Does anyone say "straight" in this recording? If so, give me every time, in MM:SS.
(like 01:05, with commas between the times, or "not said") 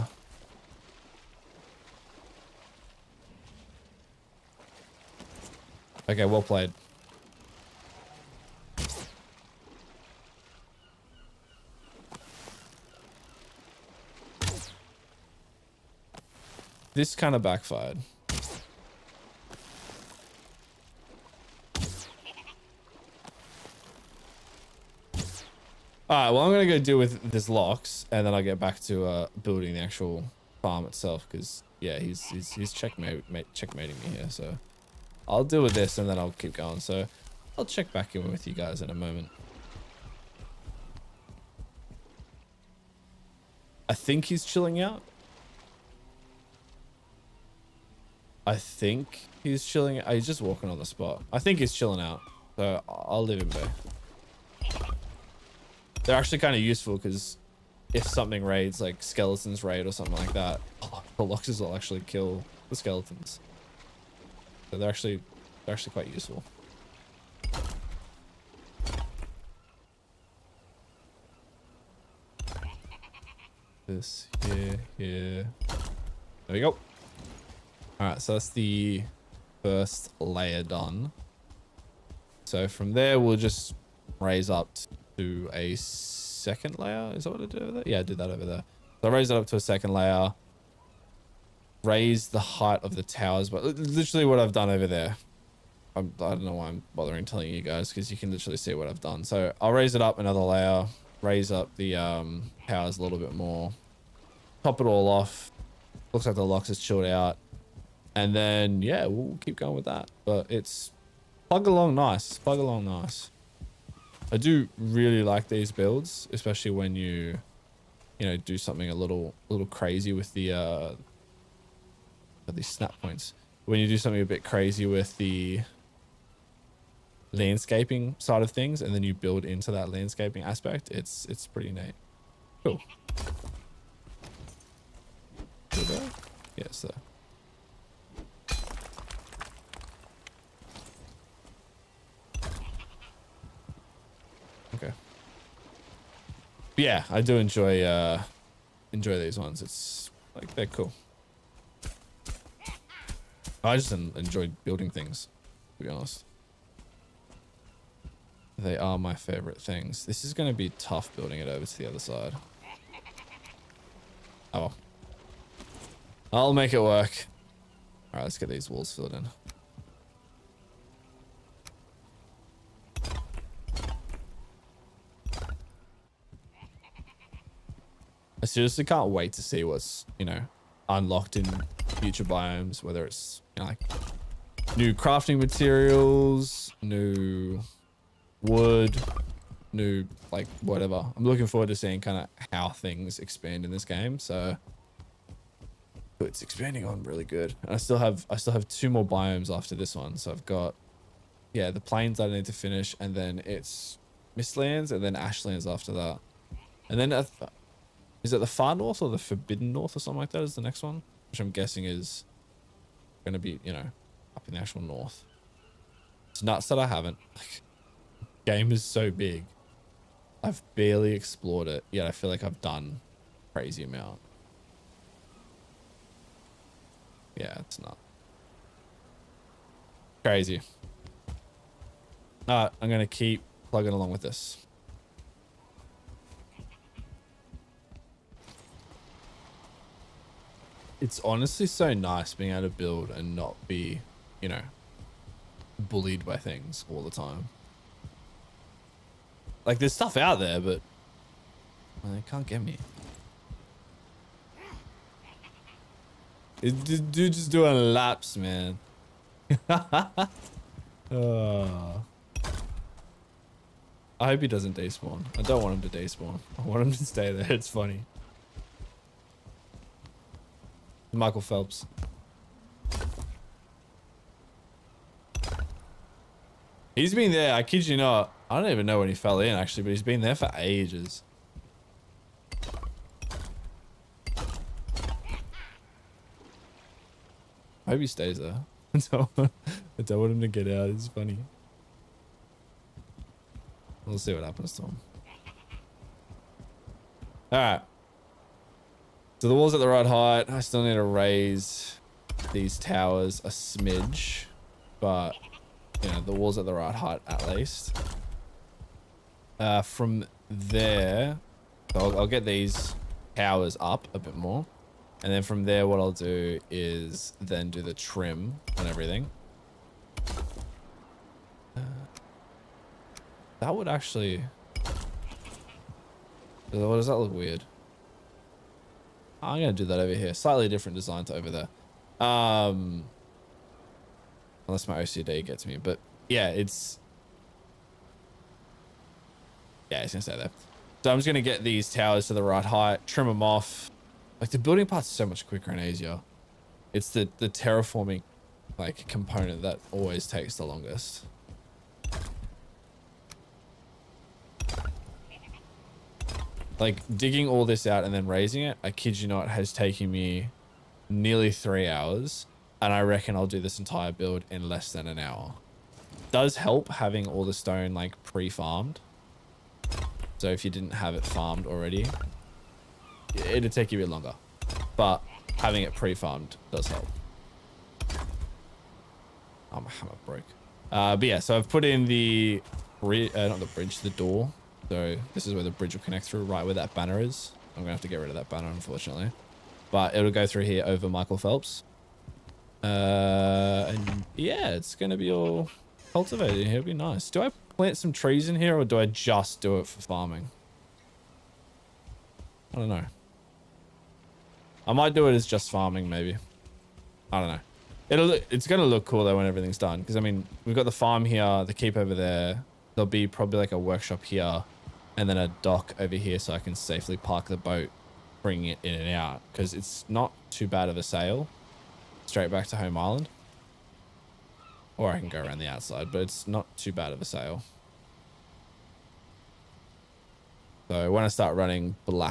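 07:02.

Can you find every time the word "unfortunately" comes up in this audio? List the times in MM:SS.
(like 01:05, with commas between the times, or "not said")
06:28.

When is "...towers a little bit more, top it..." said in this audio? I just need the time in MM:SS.
01:42.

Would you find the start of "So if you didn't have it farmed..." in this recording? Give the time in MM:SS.
06:10.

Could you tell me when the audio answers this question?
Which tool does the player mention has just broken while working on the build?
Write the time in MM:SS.
06:19.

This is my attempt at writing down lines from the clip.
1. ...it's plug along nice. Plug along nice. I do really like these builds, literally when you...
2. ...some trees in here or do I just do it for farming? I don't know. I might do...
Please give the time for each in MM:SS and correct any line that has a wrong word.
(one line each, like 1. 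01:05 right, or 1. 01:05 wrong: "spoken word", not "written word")
1. 01:50 wrong: "especially", not "literally"
2. 06:37 right.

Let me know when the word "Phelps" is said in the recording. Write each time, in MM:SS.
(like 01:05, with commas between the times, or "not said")
04:31, 06:31.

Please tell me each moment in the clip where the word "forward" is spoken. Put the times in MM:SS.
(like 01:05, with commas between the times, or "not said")
03:11.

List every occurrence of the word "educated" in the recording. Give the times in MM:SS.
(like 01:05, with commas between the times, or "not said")
not said.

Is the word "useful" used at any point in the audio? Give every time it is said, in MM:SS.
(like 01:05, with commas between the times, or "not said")
00:56, 01:06.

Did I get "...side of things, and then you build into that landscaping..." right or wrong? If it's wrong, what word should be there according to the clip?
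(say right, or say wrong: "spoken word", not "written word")
right.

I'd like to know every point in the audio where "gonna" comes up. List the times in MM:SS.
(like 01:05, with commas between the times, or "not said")
03:52.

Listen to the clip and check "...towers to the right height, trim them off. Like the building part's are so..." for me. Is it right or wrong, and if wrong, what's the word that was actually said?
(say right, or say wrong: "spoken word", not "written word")
right.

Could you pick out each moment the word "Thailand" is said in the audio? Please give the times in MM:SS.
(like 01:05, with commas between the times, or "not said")
not said.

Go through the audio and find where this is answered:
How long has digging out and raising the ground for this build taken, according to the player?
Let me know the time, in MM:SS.
06:01.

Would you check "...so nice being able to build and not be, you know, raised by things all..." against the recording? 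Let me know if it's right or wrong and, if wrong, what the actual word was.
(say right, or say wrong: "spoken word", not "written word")
wrong: "bullied", not "raised".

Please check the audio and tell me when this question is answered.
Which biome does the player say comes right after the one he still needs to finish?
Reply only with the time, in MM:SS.
03:24.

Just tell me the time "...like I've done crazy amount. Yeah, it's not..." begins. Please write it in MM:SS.
03:42.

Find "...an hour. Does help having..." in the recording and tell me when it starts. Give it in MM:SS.
06:05.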